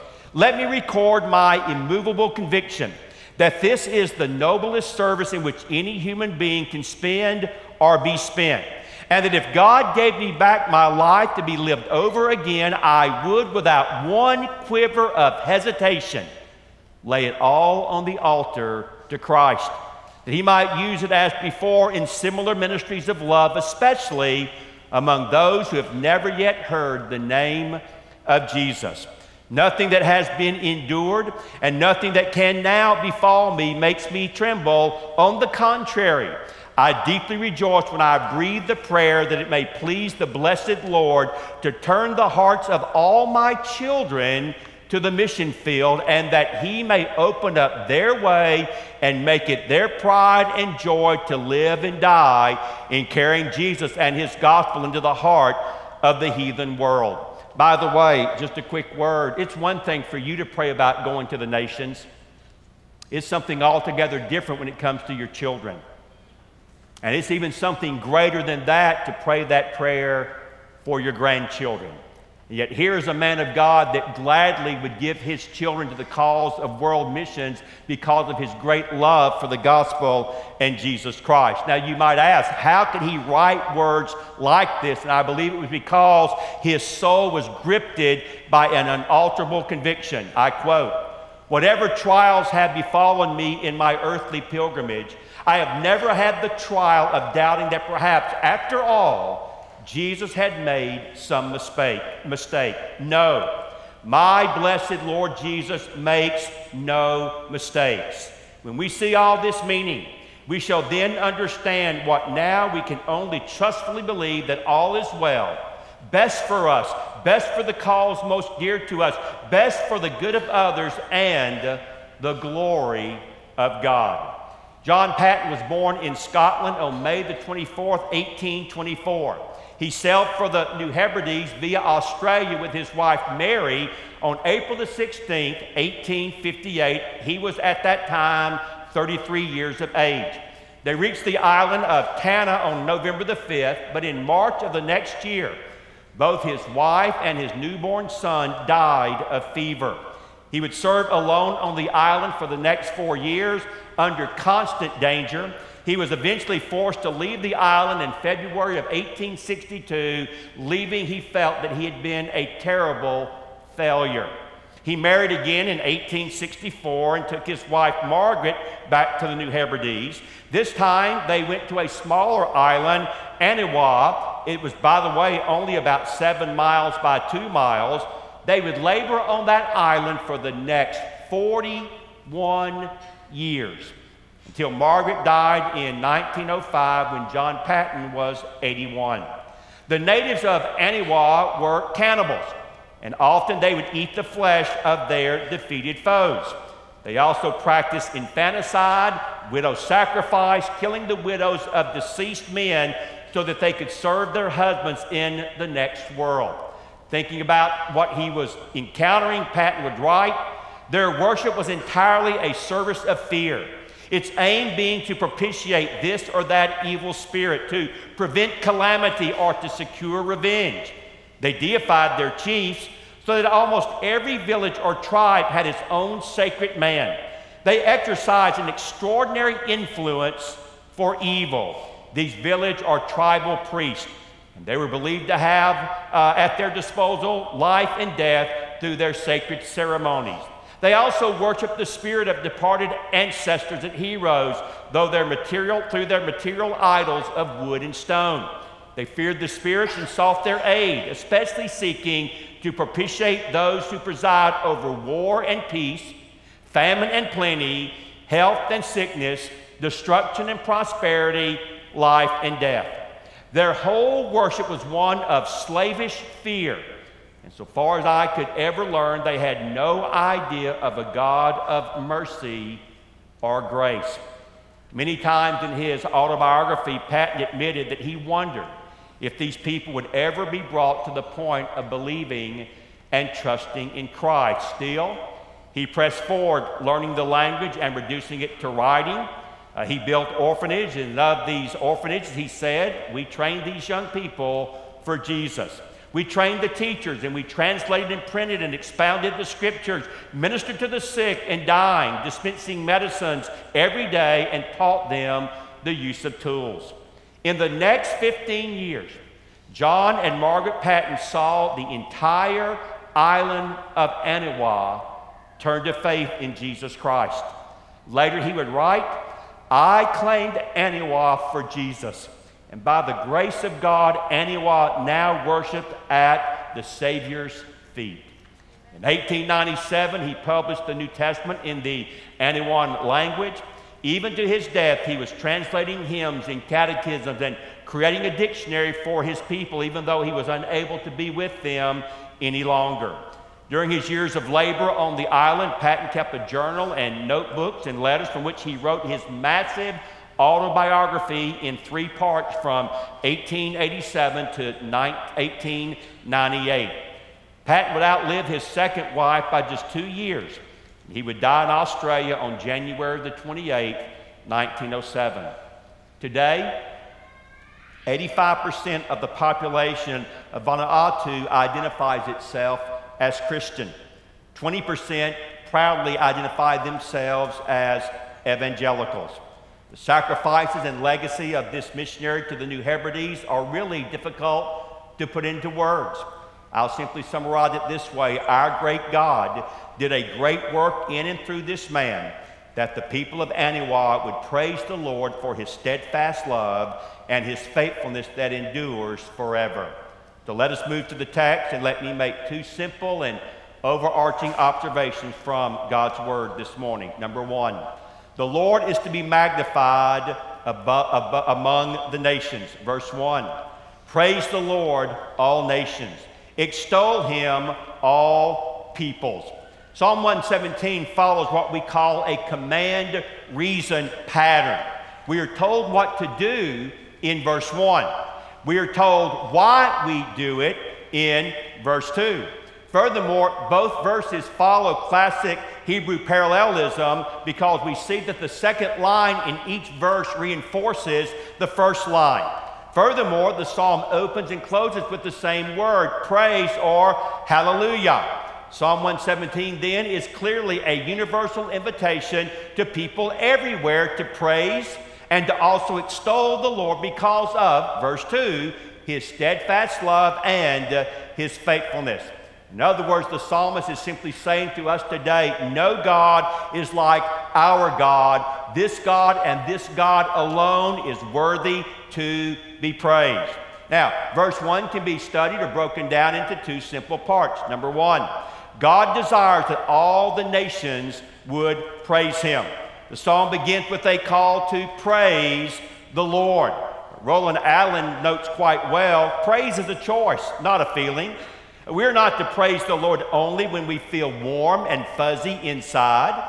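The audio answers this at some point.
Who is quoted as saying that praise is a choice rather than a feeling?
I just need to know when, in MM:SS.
08:07.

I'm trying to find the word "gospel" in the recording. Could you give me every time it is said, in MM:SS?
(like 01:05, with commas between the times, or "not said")
00:54, 01:19.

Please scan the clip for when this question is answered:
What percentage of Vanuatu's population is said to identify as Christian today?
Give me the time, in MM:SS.
06:08.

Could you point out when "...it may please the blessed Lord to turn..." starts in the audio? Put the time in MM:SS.
00:39.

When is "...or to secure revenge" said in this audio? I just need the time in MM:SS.
03:39.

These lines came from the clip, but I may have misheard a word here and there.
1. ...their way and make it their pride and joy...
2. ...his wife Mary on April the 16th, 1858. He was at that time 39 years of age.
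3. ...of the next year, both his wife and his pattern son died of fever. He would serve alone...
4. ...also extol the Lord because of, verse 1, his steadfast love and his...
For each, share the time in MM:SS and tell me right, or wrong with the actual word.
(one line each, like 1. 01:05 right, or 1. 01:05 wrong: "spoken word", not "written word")
1. 00:47 right
2. 02:12 wrong: "33", not "39"
3. 02:24 wrong: "newborn", not "pattern"
4. 07:35 wrong: "2", not "1".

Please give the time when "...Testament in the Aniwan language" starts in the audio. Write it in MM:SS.
05:31.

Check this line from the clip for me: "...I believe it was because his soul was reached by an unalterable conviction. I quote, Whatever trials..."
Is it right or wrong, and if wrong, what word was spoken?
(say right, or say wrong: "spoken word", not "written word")
wrong: "gripped", not "reached".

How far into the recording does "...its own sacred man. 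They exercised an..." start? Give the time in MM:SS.
03:45.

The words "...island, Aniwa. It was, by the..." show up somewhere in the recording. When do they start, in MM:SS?
02:52.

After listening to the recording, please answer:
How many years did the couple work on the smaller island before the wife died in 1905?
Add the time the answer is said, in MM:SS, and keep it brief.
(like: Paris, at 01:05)
41, at 03:01.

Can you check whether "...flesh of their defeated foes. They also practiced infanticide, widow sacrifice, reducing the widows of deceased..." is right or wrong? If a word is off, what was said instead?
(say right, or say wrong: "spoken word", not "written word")
wrong: "killing", not "reducing".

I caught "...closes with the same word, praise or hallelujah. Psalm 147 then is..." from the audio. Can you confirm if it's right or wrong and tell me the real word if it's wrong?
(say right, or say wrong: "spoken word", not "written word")
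wrong: "117", not "147".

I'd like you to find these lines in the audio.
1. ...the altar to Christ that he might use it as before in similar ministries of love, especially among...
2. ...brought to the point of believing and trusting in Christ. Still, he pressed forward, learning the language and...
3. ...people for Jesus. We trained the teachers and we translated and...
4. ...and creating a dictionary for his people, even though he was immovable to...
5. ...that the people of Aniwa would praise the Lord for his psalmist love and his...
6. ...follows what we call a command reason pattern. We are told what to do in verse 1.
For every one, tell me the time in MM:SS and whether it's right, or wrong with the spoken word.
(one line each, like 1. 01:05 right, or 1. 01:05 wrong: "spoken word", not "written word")
1. 00:18 right
2. 04:40 right
3. 04:54 right
4. 05:37 wrong: "unable", not "immovable"
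5. 06:32 wrong: "steadfast", not "psalmist"
6. 07:01 right.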